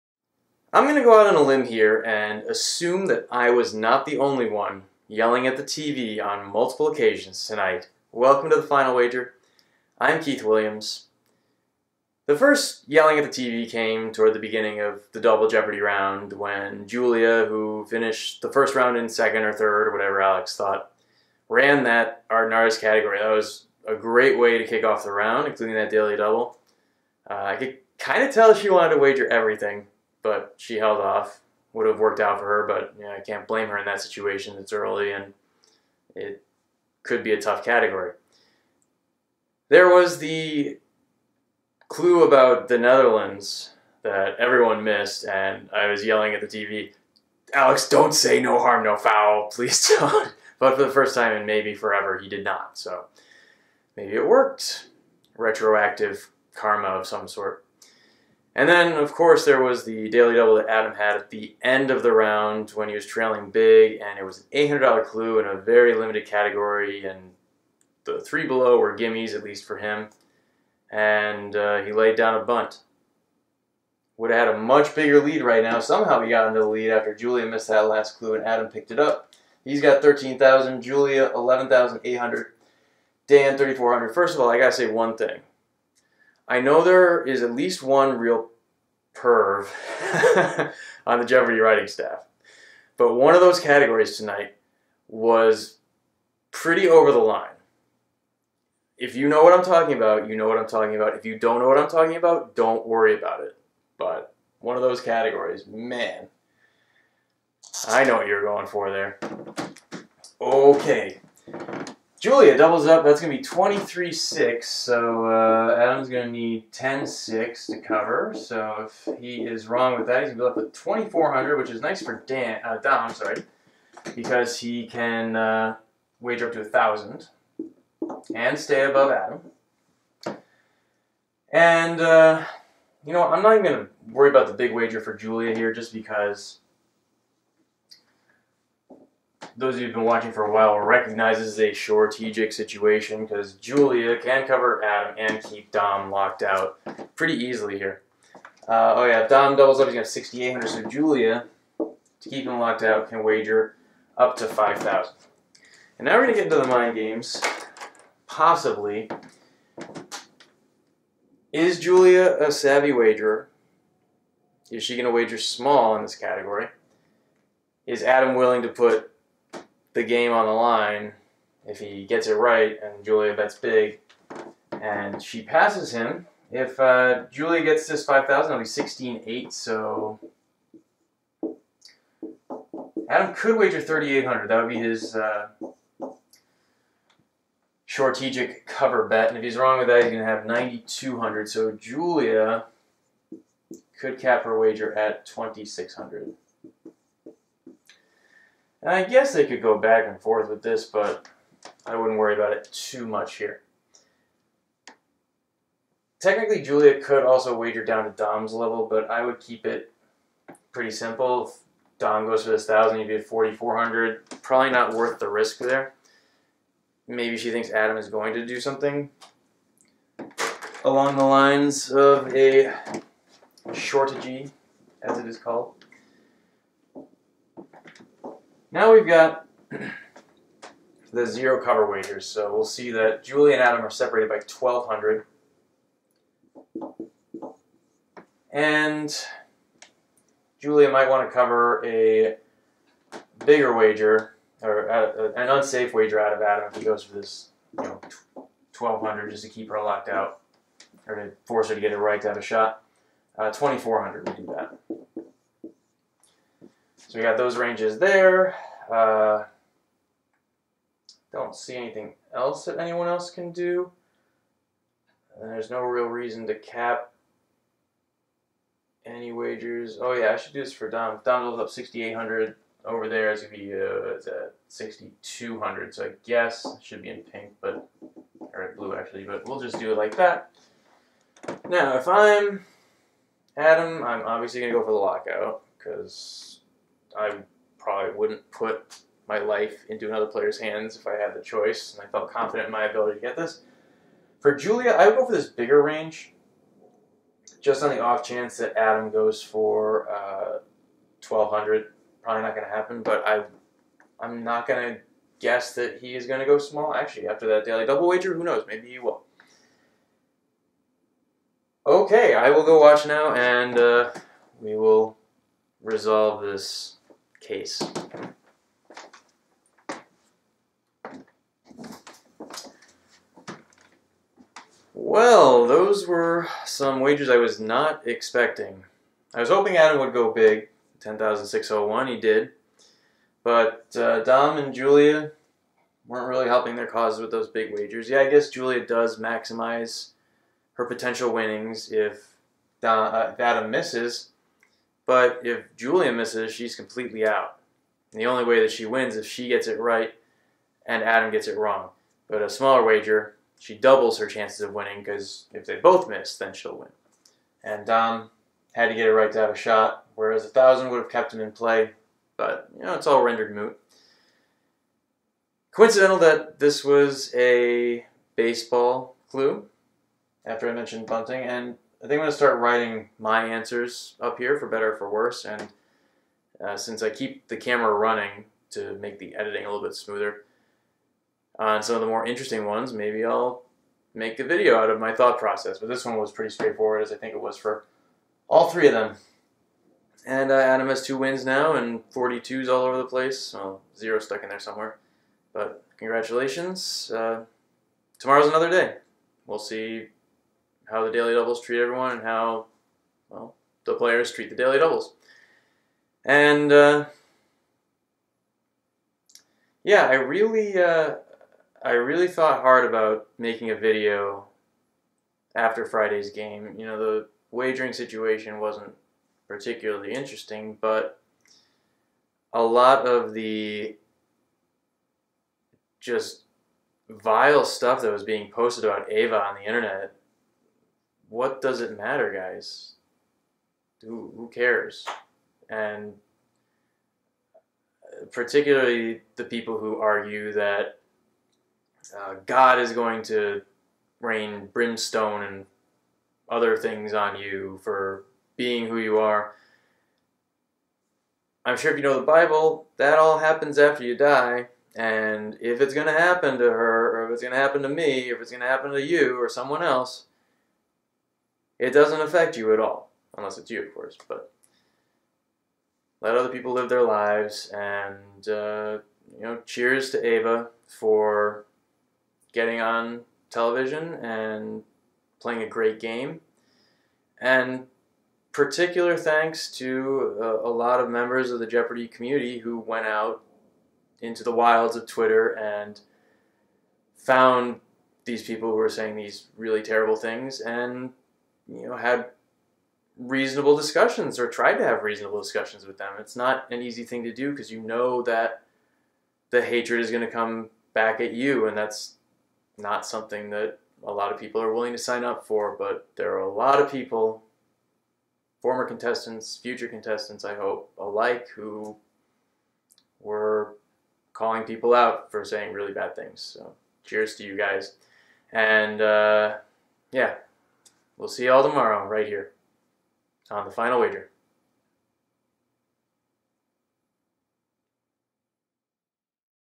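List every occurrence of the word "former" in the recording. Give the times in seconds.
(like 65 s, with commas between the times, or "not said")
508 s.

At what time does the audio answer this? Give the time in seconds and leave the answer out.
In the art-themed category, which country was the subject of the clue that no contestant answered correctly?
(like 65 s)
42 s.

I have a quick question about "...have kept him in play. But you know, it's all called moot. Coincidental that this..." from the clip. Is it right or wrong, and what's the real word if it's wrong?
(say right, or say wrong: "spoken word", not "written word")
wrong: "rendered", not "called".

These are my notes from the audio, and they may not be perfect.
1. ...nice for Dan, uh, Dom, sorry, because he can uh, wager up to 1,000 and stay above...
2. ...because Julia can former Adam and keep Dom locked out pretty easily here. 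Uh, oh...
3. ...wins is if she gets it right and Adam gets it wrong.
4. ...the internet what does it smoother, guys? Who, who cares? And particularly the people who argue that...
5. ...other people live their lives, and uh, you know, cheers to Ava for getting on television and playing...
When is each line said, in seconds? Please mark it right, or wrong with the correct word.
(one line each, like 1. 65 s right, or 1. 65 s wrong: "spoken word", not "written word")
1. 121 s right
2. 143 s wrong: "cover", not "former"
3. 348 s right
4. 429 s wrong: "matter", not "smoother"
5. 466 s right.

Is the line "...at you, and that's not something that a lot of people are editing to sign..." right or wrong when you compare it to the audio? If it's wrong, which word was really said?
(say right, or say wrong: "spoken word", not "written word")
wrong: "willing", not "editing".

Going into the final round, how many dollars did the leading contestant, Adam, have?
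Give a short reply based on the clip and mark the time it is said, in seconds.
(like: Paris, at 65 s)
13,000, at 80 s.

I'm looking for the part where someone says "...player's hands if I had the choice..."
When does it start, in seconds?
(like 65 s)
290 s.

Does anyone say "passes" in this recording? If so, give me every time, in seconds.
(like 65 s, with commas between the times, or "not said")
175 s.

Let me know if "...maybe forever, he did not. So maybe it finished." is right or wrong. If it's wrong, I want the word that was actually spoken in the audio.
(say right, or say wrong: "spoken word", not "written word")
wrong: "worked", not "finished".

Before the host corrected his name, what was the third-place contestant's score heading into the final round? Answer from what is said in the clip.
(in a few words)
3,400.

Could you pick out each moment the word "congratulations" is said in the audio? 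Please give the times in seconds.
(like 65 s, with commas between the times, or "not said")
395 s.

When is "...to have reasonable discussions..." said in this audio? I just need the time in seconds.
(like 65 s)
494 s.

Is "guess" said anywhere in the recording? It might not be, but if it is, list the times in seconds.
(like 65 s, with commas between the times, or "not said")
199 s, 276 s, 305 s, 338 s.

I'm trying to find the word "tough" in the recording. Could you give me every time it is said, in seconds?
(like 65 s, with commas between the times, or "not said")
37 s.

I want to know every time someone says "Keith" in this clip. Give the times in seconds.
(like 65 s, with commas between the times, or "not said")
10 s.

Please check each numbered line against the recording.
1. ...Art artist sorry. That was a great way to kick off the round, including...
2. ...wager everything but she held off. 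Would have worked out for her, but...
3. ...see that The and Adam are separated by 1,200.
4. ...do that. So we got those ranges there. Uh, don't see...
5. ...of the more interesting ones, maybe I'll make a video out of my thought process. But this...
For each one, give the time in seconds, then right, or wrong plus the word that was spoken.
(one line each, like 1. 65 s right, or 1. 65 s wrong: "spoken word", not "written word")
1. 22 s wrong: "category", not "sorry"
2. 29 s right
3. 232 s wrong: "Julie", not "The"
4. 254 s right
5. 381 s right.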